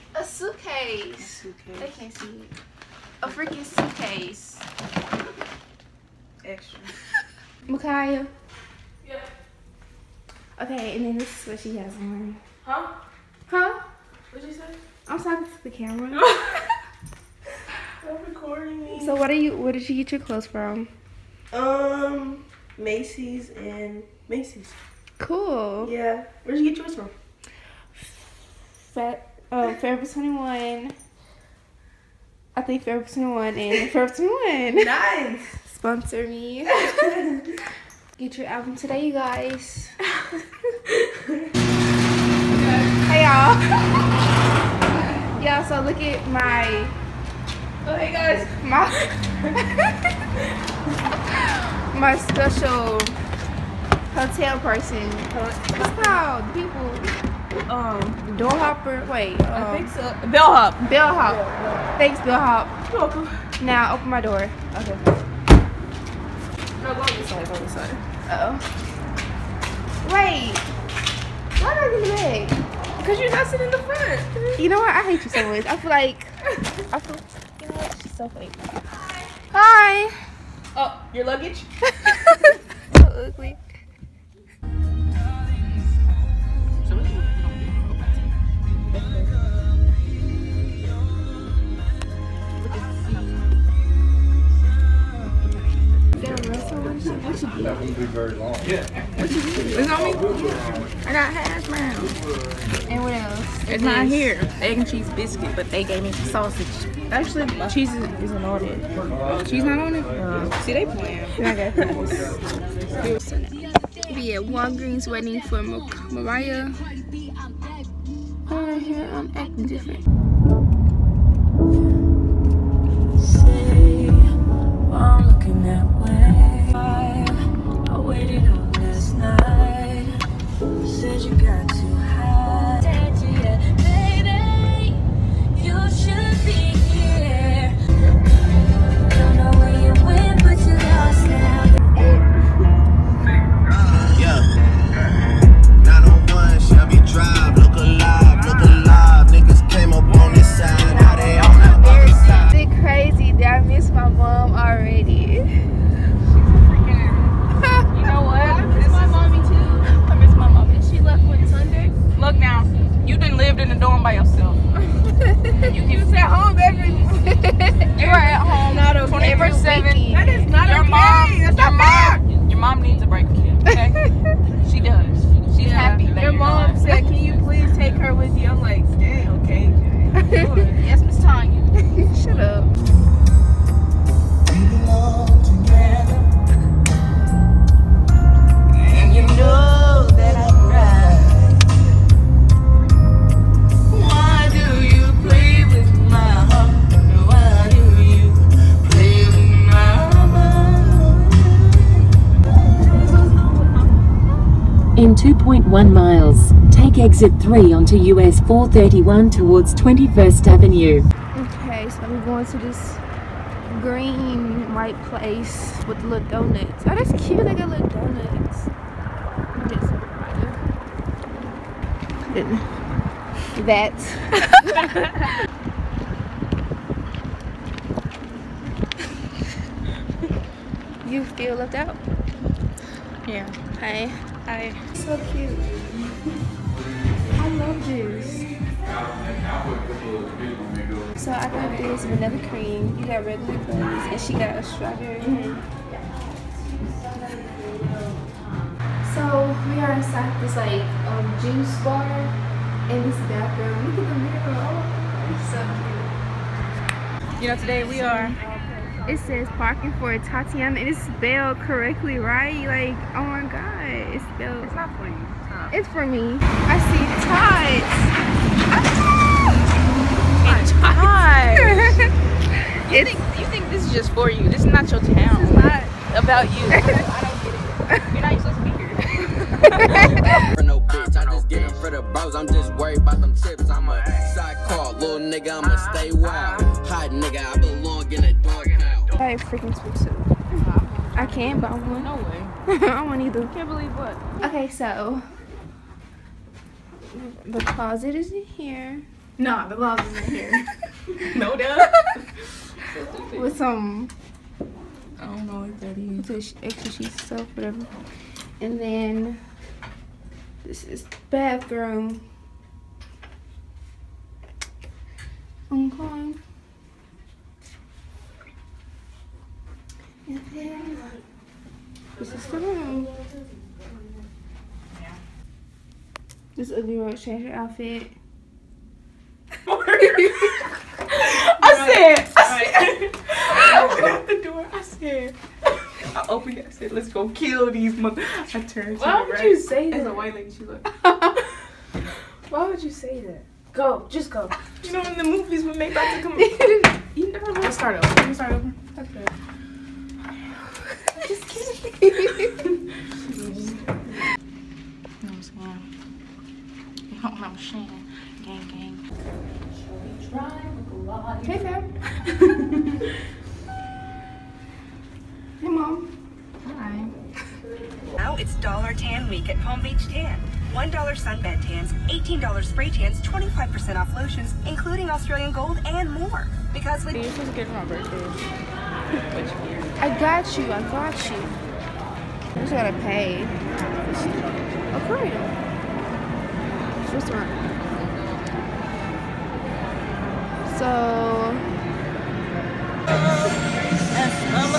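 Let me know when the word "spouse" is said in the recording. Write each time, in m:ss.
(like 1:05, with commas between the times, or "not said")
not said.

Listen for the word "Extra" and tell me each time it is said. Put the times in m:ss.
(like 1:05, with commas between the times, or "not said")
0:06, 5:06.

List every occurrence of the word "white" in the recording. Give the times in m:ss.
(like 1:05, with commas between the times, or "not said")
3:34, 5:40.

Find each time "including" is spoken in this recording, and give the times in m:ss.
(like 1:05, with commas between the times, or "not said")
6:14.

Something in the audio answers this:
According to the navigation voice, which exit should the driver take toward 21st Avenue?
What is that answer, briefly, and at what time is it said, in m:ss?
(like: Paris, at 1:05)
Exit 3, at 3:26.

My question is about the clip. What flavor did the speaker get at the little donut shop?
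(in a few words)
Vanilla cream.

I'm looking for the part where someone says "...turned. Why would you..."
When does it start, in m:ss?
5:38.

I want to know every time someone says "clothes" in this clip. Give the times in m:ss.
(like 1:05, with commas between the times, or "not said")
0:20.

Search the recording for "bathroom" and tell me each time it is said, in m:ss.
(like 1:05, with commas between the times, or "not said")
4:13, 5:11.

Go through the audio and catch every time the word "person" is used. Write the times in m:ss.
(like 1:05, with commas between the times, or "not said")
0:54.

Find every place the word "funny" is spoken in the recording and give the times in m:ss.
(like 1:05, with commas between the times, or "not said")
1:18.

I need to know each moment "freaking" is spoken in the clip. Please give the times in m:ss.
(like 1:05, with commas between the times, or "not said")
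0:03, 4:49.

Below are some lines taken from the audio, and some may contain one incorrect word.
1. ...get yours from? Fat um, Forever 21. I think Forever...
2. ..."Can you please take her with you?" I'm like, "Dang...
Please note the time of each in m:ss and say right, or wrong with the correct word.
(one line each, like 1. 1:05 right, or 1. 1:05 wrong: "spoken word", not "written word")
1. 0:26 right
2. 2:57 right.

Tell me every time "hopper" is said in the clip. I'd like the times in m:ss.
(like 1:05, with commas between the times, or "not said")
0:58.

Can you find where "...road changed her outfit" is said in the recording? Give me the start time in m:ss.
5:26.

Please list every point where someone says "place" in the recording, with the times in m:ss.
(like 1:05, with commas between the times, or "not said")
3:35.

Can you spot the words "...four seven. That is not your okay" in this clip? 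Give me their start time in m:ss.
2:49.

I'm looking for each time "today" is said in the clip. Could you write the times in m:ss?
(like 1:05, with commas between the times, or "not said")
0:38, 4:17.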